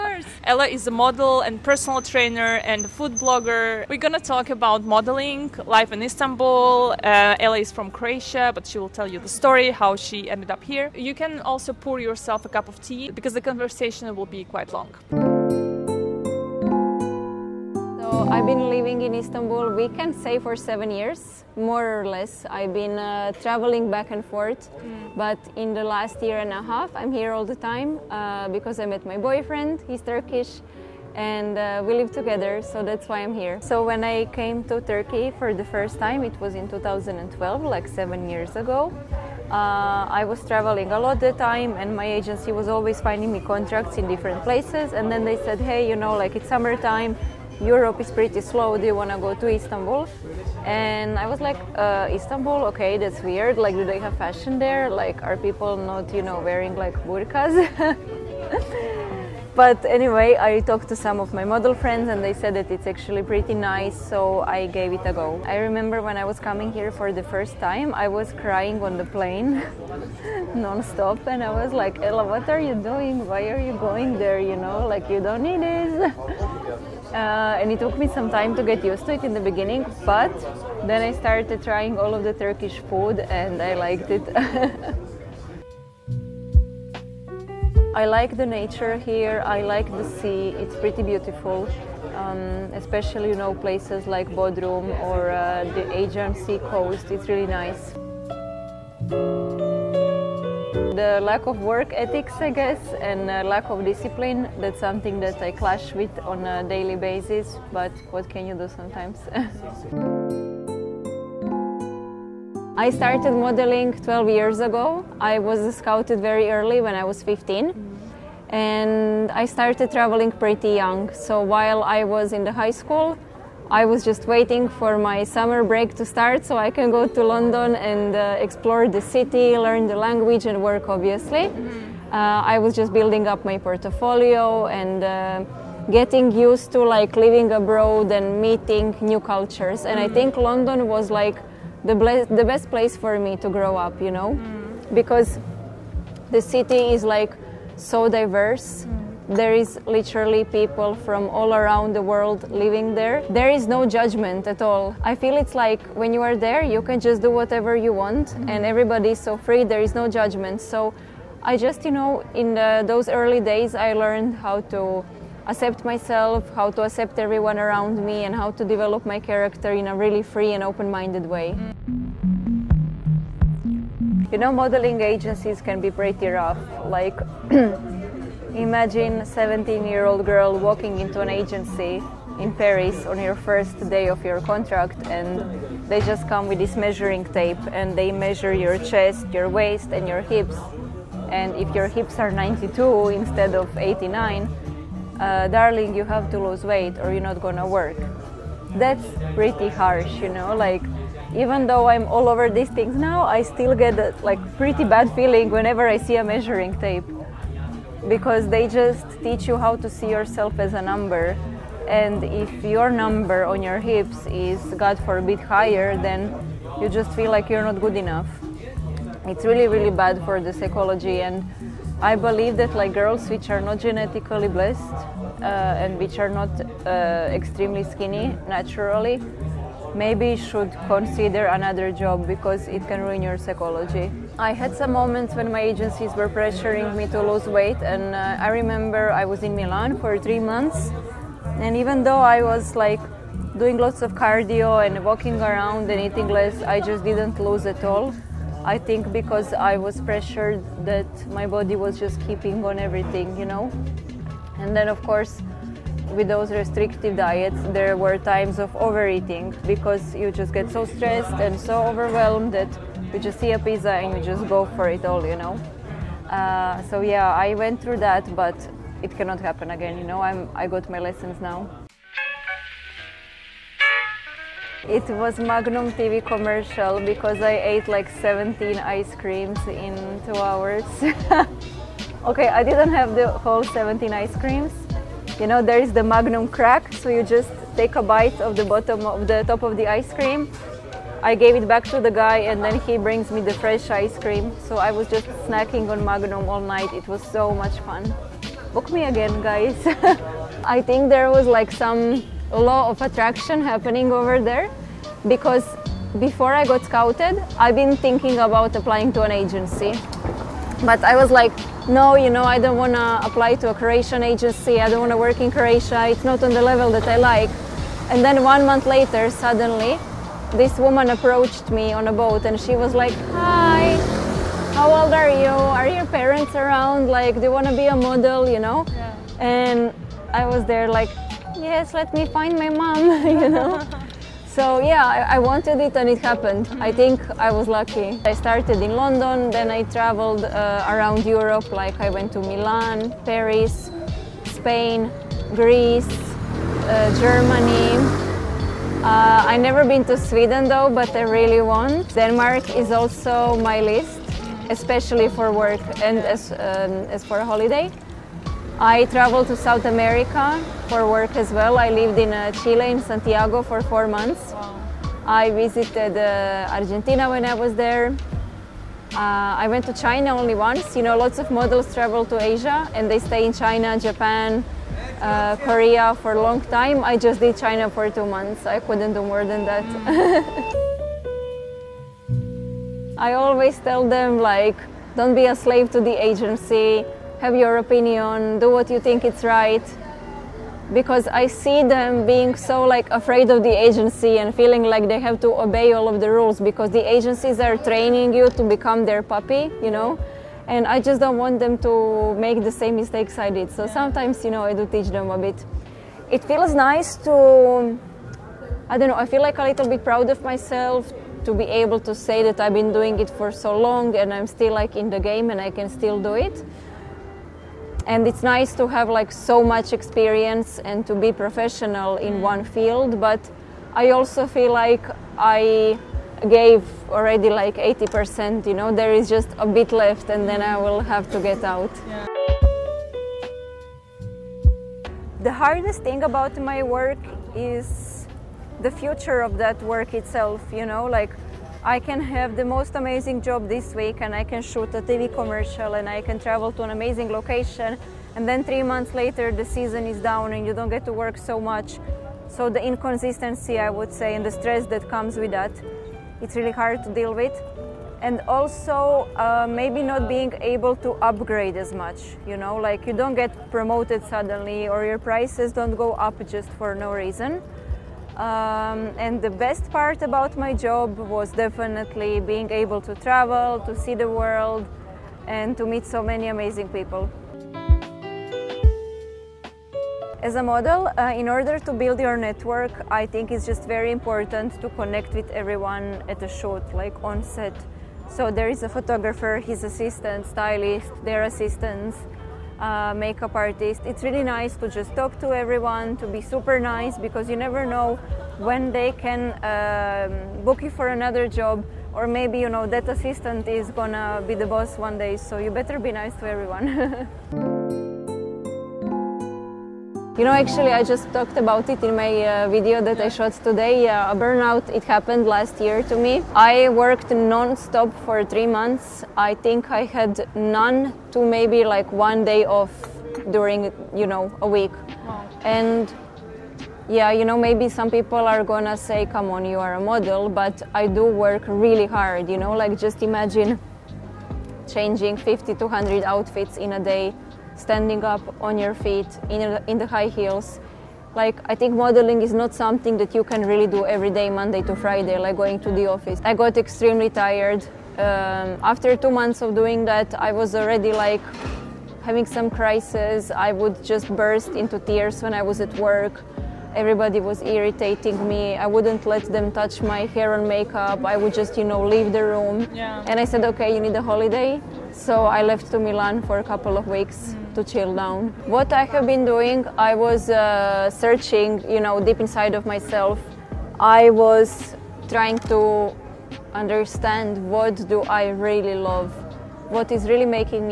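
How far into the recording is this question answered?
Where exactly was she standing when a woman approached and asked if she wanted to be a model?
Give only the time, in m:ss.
5:21.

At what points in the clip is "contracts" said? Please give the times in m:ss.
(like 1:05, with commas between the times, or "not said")
0:43, 3:04.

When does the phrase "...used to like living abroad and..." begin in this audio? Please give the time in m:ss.
2:16.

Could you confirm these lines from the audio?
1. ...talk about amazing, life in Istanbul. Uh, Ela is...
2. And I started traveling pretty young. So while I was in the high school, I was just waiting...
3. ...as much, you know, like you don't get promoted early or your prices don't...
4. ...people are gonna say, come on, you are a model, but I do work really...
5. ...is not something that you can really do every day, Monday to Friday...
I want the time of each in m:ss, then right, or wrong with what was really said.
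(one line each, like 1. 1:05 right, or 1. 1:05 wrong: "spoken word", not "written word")
1. 0:04 wrong: "modeling", not "amazing"
2. 1:58 right
3. 7:41 wrong: "suddenly", not "early"
4. 8:48 right
5. 9:02 right.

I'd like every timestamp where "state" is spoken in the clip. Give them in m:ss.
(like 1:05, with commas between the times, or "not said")
not said.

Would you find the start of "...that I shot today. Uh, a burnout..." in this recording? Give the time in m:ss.
8:33.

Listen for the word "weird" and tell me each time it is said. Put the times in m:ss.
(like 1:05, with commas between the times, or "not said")
0:53.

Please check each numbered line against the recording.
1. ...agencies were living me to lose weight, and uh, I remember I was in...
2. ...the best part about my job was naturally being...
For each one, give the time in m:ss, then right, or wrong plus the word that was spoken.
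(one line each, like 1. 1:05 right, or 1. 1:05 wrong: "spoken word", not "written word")
1. 3:55 wrong: "pressuring", not "living"
2. 7:49 wrong: "definitely", not "naturally".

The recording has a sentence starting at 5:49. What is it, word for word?
Uh, i never been to Sweden though, but I really want.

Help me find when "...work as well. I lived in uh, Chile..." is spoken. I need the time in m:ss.
6:01.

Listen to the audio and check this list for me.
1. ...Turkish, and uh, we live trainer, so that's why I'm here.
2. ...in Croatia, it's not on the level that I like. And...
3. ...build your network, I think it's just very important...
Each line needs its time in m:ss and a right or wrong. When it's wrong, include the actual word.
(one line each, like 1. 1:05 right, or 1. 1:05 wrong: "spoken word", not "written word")
1. 0:30 wrong: "together", not "trainer"
2. 5:15 right
3. 8:01 right.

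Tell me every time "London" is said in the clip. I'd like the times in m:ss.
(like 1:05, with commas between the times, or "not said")
2:07, 2:20, 5:38.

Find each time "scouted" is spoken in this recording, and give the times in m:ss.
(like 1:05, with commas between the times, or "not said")
1:55, 5:06.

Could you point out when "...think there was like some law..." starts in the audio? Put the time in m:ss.
5:00.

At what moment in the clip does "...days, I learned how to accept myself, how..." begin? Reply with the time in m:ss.
2:43.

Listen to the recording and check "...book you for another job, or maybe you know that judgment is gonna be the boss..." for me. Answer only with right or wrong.
wrong.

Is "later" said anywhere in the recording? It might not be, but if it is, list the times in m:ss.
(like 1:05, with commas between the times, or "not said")
5:18, 7:29.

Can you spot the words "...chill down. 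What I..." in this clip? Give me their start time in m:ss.
9:27.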